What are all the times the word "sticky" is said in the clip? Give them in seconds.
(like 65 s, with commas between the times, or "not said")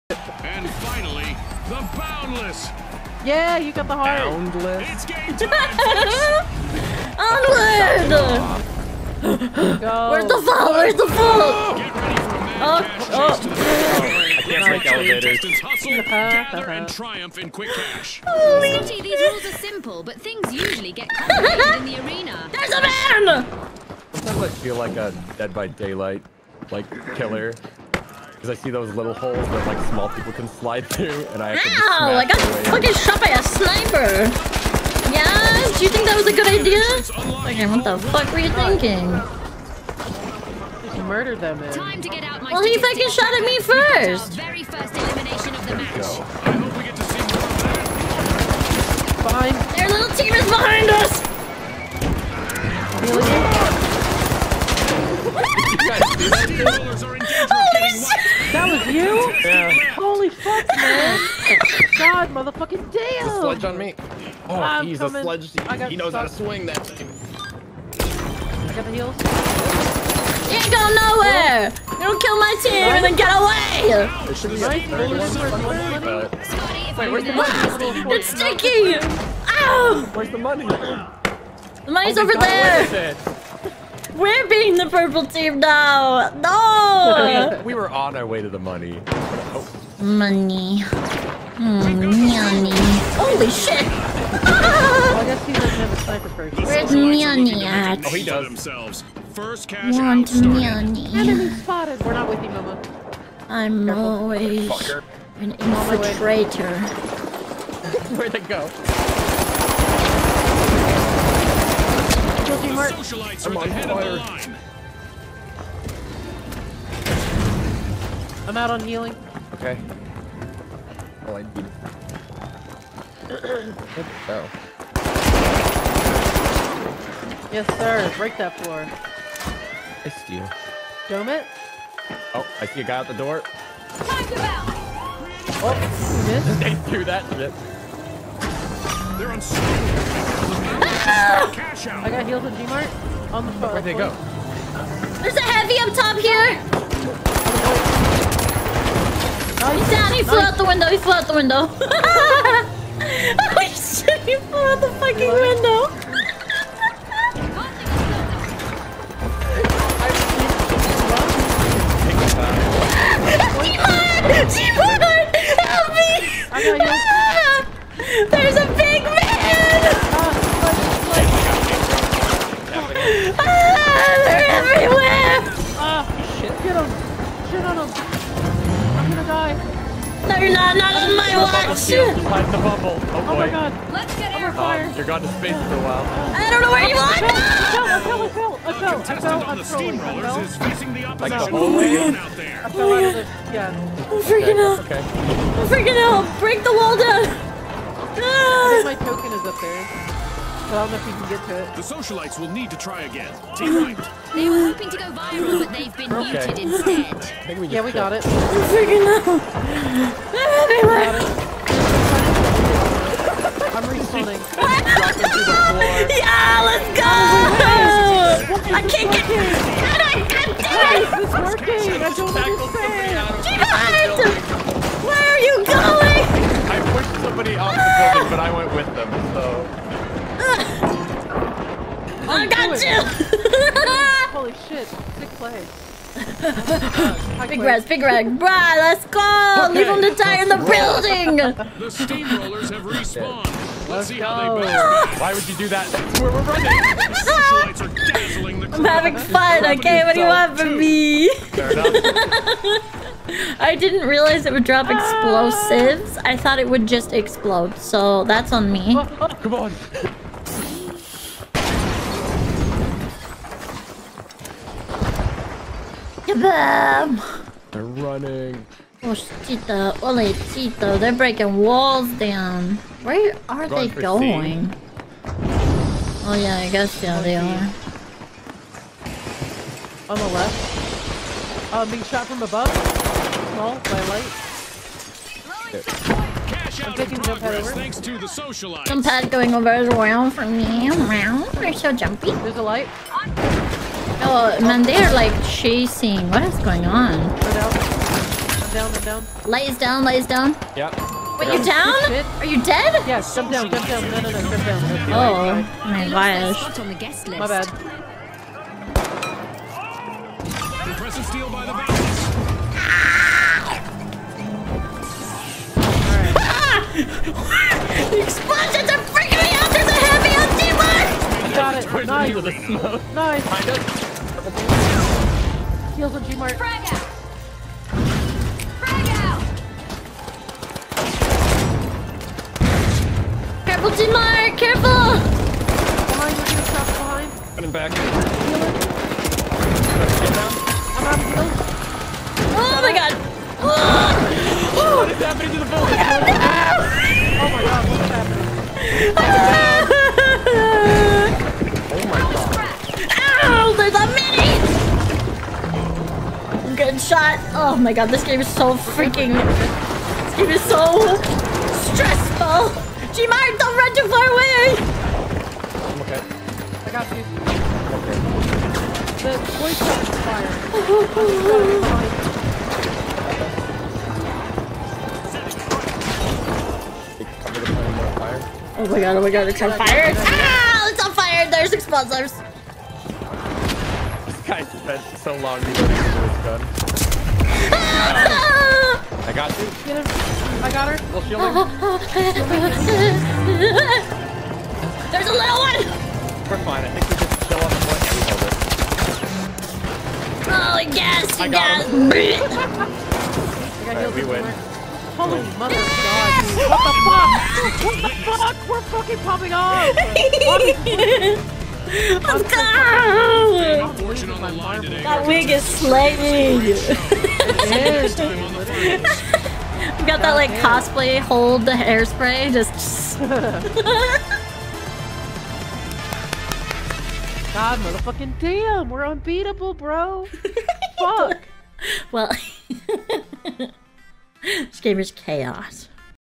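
78 s.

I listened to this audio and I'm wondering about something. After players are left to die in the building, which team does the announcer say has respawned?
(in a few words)
The steamrollers.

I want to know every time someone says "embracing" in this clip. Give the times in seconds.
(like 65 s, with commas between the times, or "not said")
not said.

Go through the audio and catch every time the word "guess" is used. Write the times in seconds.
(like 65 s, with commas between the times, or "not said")
276 s.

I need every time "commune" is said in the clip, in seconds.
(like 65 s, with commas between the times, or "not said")
not said.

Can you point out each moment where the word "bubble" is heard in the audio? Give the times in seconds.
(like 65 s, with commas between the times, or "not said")
182 s.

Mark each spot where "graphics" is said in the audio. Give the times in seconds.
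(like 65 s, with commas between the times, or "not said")
not said.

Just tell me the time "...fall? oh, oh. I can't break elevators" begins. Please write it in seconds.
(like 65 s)
11 s.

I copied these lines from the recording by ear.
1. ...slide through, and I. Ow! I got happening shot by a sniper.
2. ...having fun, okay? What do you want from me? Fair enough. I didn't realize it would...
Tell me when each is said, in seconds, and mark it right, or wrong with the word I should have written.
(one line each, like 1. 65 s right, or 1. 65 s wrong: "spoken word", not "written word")
1. 30 s wrong: "fucking", not "happening"
2. 248 s right.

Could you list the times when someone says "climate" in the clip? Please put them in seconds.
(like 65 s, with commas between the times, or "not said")
not said.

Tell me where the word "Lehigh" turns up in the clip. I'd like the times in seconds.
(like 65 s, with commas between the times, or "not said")
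not said.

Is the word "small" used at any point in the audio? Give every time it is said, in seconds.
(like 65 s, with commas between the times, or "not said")
29 s, 283 s.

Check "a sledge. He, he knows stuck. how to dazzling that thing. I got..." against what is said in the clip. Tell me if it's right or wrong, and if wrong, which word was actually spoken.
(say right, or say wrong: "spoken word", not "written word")
wrong: "swing", not "dazzling".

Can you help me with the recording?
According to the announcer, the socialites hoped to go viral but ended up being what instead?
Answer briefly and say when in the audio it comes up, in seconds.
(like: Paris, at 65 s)
Muted, at 206 s.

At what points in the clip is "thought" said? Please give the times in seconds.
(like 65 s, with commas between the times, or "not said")
256 s.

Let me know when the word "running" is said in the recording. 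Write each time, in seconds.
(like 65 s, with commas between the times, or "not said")
246 s, 267 s, 337 s.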